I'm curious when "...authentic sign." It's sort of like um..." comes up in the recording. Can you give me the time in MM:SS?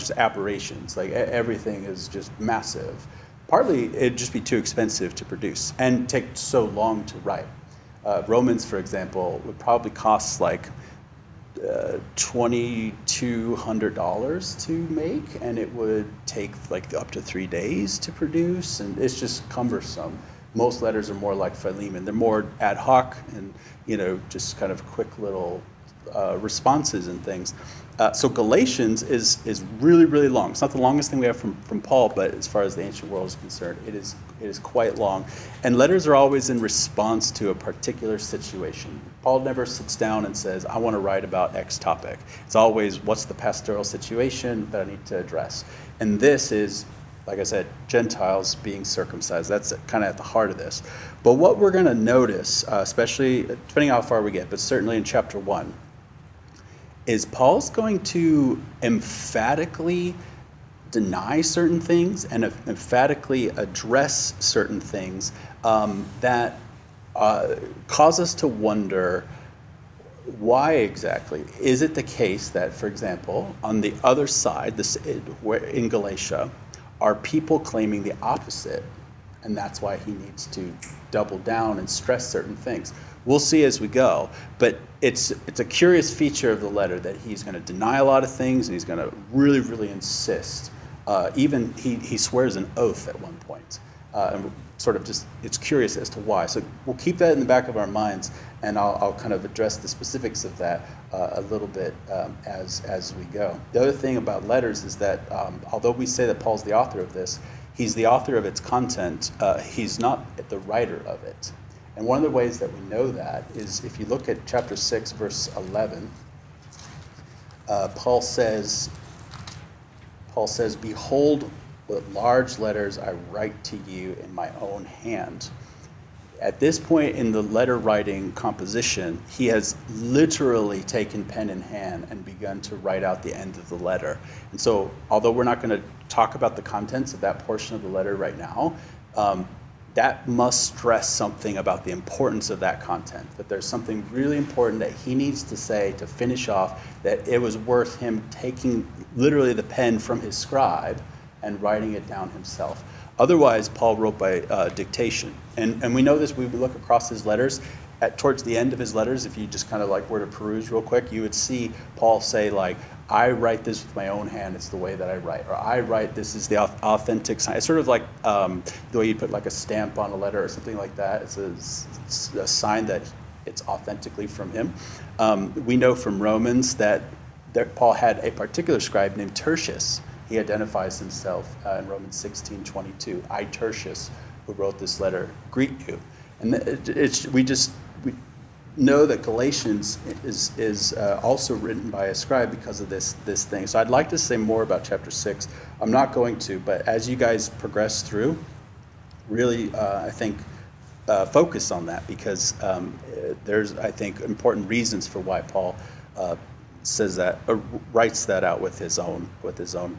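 02:46.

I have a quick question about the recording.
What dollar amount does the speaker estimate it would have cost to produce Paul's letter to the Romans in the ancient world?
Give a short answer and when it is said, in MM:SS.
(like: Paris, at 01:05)
$2200, at 00:12.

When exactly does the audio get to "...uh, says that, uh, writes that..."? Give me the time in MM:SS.
03:26.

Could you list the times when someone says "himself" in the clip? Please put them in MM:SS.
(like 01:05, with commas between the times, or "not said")
02:32, 03:00.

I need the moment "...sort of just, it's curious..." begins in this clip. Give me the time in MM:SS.
01:34.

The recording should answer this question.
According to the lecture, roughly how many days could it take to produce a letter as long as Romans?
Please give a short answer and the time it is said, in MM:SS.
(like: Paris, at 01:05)
3 days, at 00:17.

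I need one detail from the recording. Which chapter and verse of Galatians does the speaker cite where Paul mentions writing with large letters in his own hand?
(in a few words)
Chapter 6, verse 11.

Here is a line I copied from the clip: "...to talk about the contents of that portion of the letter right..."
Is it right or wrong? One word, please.
right.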